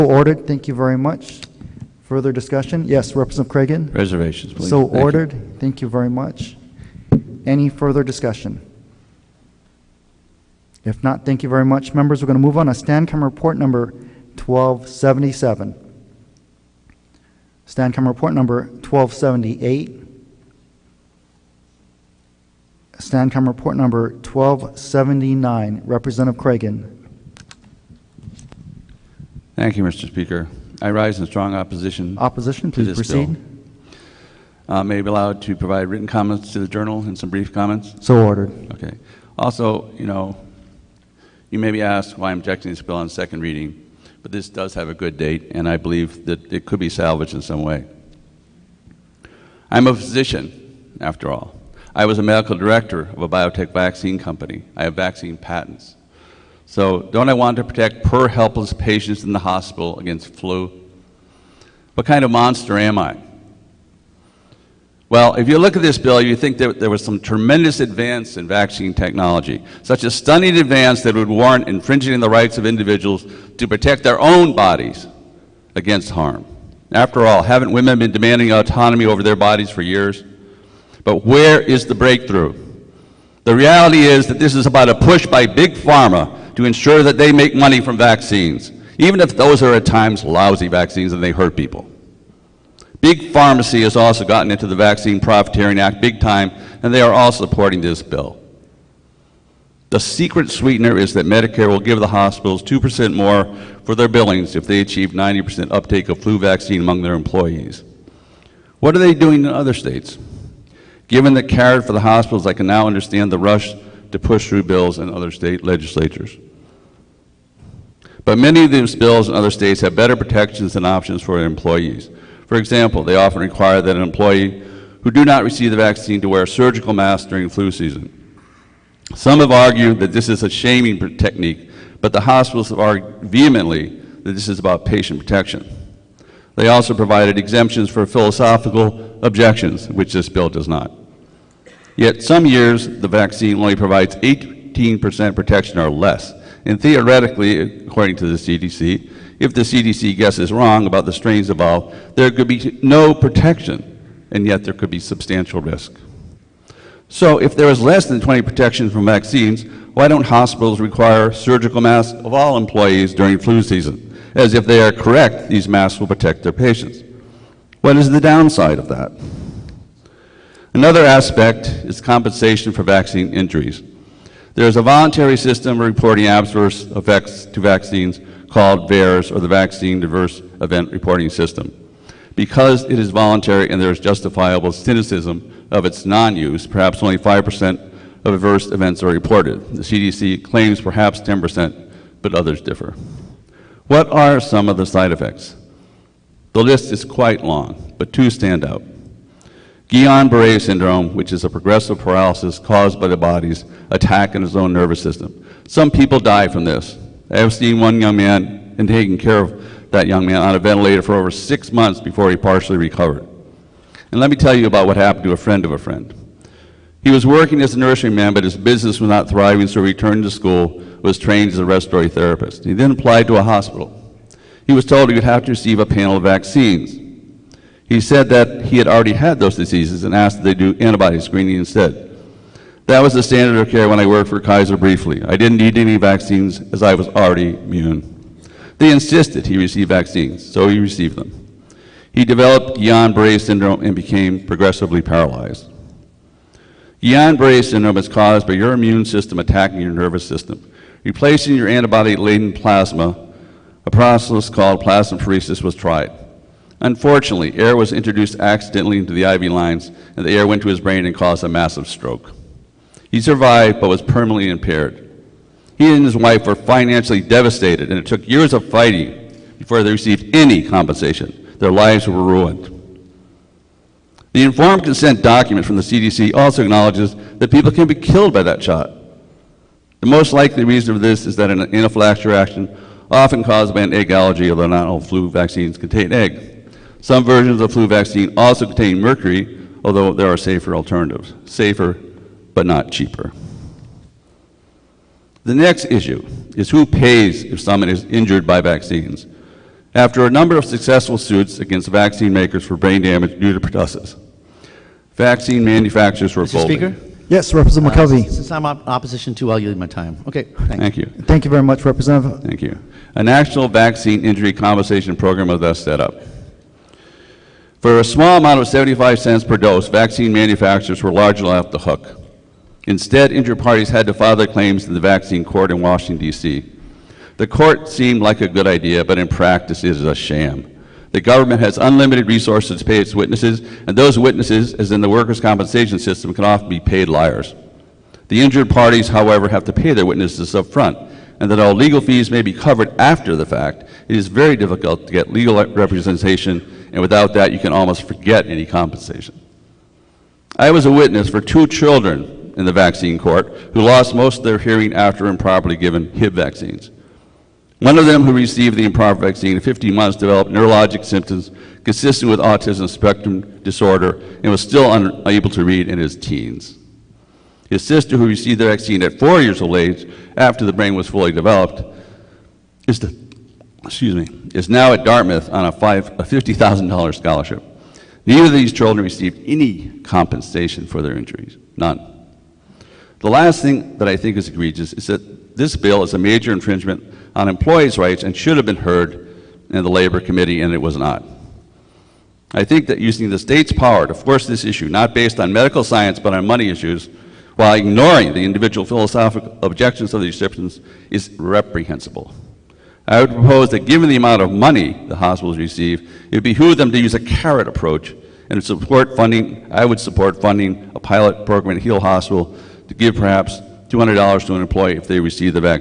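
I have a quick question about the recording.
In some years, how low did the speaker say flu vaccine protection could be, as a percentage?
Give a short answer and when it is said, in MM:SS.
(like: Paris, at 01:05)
18%, at 02:24.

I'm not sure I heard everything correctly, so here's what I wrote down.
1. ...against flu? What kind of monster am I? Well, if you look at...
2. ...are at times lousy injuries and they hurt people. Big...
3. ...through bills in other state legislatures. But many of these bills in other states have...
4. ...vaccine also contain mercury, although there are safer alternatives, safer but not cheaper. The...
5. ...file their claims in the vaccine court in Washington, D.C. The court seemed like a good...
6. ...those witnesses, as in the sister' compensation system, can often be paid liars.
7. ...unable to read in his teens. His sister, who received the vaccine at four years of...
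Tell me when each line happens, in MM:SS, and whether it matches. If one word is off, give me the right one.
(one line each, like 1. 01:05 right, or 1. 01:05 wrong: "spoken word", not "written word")
1. 00:59 right
2. 01:29 wrong: "vaccines", not "injuries"
3. 01:54 right
4. 04:47 right
5. 05:24 right
6. 05:33 wrong: "workers", not "sister"
7. 06:04 right.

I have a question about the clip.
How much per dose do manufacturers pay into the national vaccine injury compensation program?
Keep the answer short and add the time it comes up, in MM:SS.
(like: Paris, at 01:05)
75 cents, at 05:18.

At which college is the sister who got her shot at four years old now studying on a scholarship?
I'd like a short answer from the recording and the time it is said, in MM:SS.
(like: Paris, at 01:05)
Dartmouth, at 06:15.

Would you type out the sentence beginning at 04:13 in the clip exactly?
A process called plasmapheresis was tried.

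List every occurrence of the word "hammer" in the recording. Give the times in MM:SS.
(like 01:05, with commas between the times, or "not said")
not said.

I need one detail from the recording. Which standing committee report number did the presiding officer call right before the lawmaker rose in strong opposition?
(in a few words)
1279.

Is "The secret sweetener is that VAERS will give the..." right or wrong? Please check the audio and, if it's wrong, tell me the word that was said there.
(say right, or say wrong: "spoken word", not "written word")
wrong: "Medicare", not "VAERS".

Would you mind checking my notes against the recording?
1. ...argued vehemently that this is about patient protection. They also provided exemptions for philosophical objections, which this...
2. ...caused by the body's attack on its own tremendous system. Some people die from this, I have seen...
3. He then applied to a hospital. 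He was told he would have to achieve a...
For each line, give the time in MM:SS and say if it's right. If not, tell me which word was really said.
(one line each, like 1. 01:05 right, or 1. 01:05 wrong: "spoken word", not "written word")
1. 02:12 right
2. 03:22 wrong: "nervous", not "tremendous"
3. 03:42 wrong: "receive", not "achieve".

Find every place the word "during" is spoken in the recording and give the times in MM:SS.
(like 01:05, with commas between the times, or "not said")
02:07, 02:43.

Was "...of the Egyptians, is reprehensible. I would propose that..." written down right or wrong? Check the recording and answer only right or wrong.
right.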